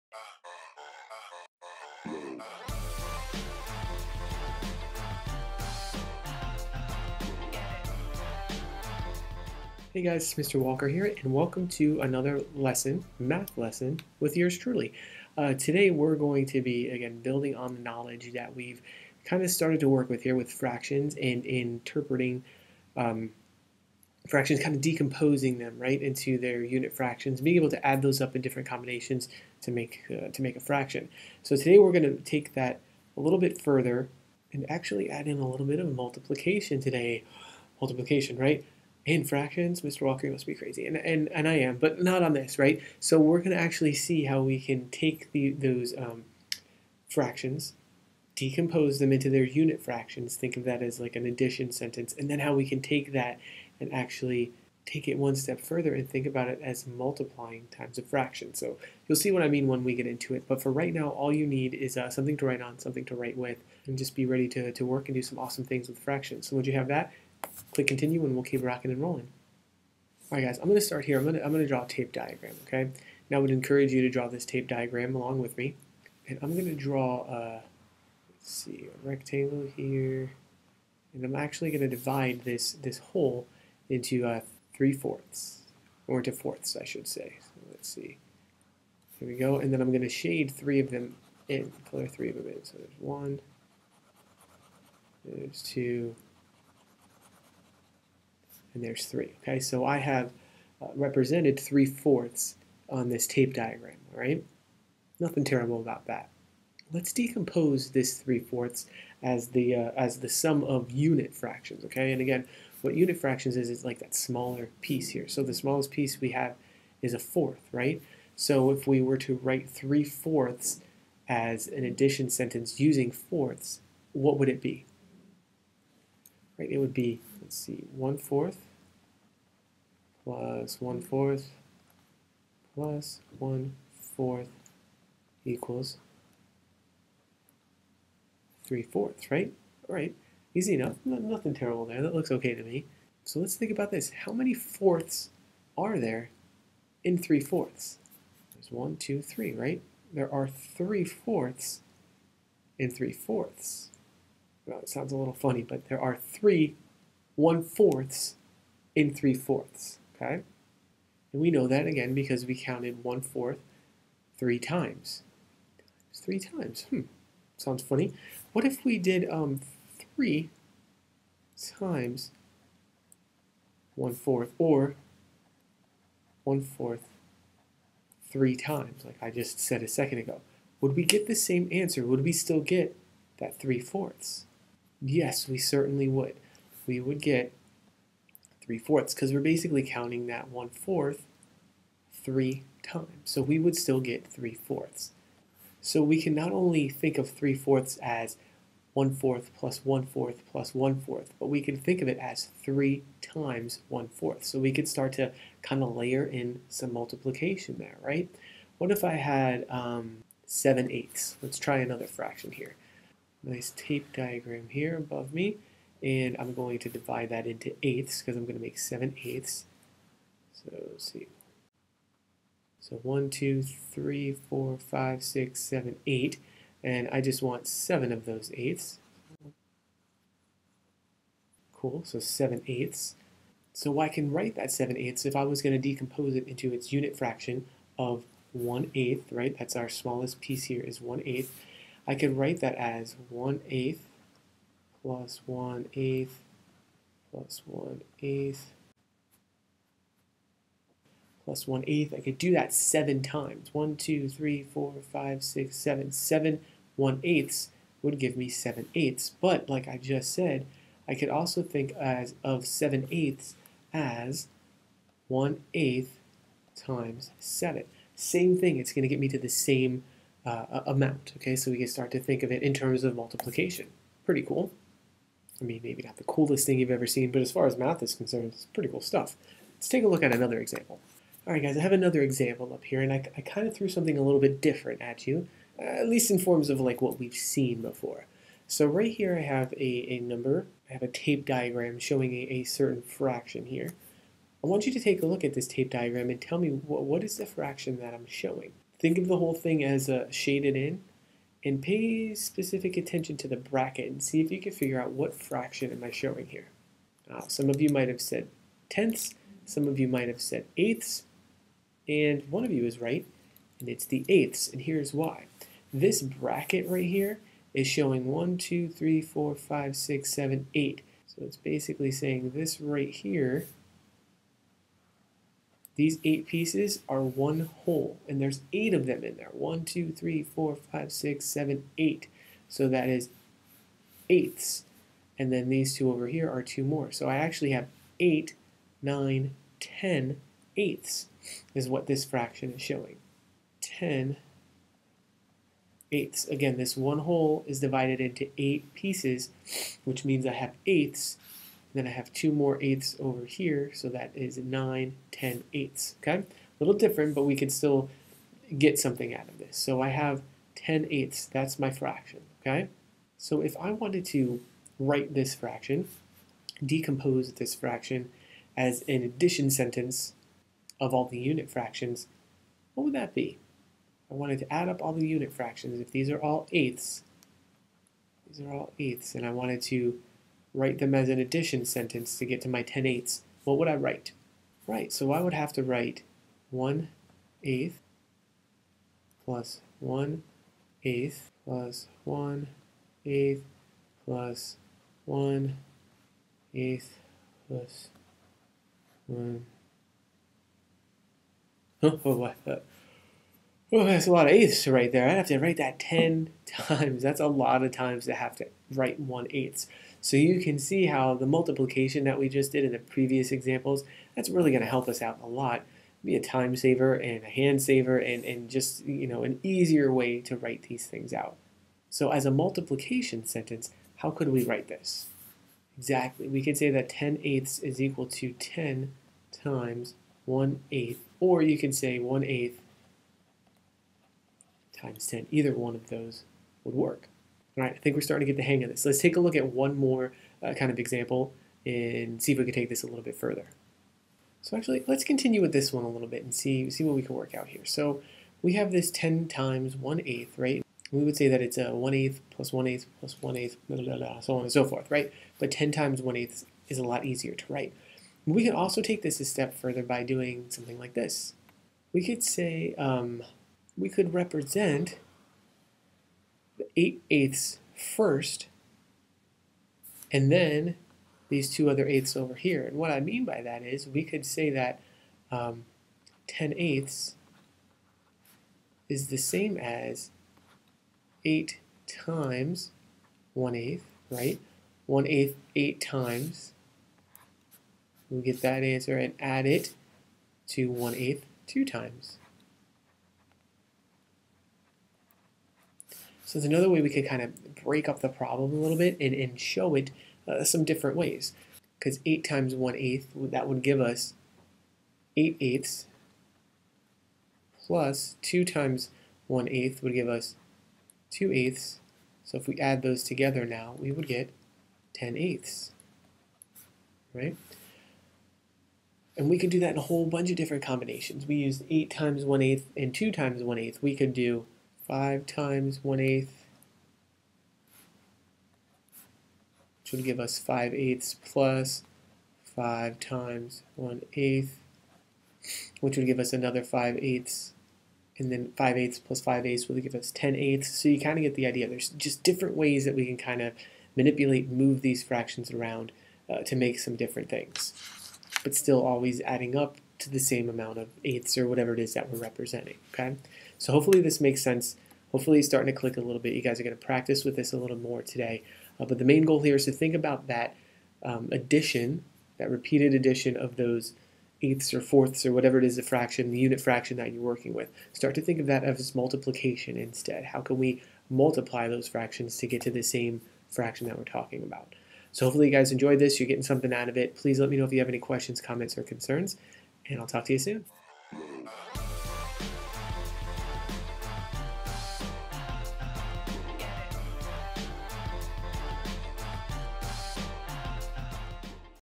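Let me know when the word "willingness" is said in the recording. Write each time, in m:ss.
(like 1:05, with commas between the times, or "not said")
not said.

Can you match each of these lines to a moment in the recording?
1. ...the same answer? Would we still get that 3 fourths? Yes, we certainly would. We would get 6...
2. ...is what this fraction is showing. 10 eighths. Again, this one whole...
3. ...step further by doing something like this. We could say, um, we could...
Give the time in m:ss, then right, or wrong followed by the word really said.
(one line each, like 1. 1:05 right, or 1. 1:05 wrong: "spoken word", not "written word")
1. 3:01 wrong: "3", not "6"
2. 5:41 right
3. 7:39 right.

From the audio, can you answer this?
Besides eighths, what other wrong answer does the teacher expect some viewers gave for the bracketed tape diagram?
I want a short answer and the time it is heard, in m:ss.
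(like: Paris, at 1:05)
tenths, at 5:08.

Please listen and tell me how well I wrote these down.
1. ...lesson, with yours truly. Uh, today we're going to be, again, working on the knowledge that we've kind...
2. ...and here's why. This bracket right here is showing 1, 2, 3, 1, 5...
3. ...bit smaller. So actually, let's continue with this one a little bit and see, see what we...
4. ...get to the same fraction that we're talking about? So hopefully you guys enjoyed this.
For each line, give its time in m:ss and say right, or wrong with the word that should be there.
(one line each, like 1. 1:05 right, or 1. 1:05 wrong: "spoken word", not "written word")
1. 0:13 wrong: "building", not "working"
2. 5:14 wrong: "4", not "1"
3. 7:23 wrong: "further", not "smaller"
4. 9:32 right.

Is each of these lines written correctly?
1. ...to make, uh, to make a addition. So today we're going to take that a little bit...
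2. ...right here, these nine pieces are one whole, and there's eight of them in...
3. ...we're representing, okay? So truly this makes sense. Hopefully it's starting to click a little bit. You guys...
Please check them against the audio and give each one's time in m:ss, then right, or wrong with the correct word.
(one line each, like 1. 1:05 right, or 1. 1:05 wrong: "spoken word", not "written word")
1. 0:29 wrong: "fraction", not "addition"
2. 5:22 wrong: "eight", not "nine"
3. 9:12 wrong: "hopefully", not "truly".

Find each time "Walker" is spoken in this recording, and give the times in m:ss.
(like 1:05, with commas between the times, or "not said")
0:10, 0:40.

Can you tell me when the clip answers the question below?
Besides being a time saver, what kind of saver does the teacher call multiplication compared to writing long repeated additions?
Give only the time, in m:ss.
6:57.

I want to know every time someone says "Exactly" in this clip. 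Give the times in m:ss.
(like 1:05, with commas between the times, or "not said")
7:05.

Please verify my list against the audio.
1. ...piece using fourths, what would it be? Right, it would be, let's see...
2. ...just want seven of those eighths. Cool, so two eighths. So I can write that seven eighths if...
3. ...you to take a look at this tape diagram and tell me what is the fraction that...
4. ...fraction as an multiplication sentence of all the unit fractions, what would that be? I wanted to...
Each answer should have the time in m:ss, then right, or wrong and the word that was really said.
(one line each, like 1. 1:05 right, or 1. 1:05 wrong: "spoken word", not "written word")
1. 2:02 wrong: "sentence", not "piece"
2. 3:47 wrong: "seven", not "two"
3. 4:54 right
4. 6:07 wrong: "addition", not "multiplication".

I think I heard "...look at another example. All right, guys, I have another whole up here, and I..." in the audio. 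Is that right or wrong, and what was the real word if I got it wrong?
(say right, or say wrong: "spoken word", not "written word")
wrong: "example", not "whole".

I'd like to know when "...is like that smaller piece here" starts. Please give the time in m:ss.
1:53.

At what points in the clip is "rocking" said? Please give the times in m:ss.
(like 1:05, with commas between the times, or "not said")
1:08.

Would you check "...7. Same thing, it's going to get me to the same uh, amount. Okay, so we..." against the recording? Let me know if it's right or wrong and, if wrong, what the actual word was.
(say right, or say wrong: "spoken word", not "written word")
right.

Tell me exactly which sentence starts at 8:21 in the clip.
Because 8 times 1 eighth, that would give us 8 eighths plus 2 times 1 eighth would give us 2 eighths.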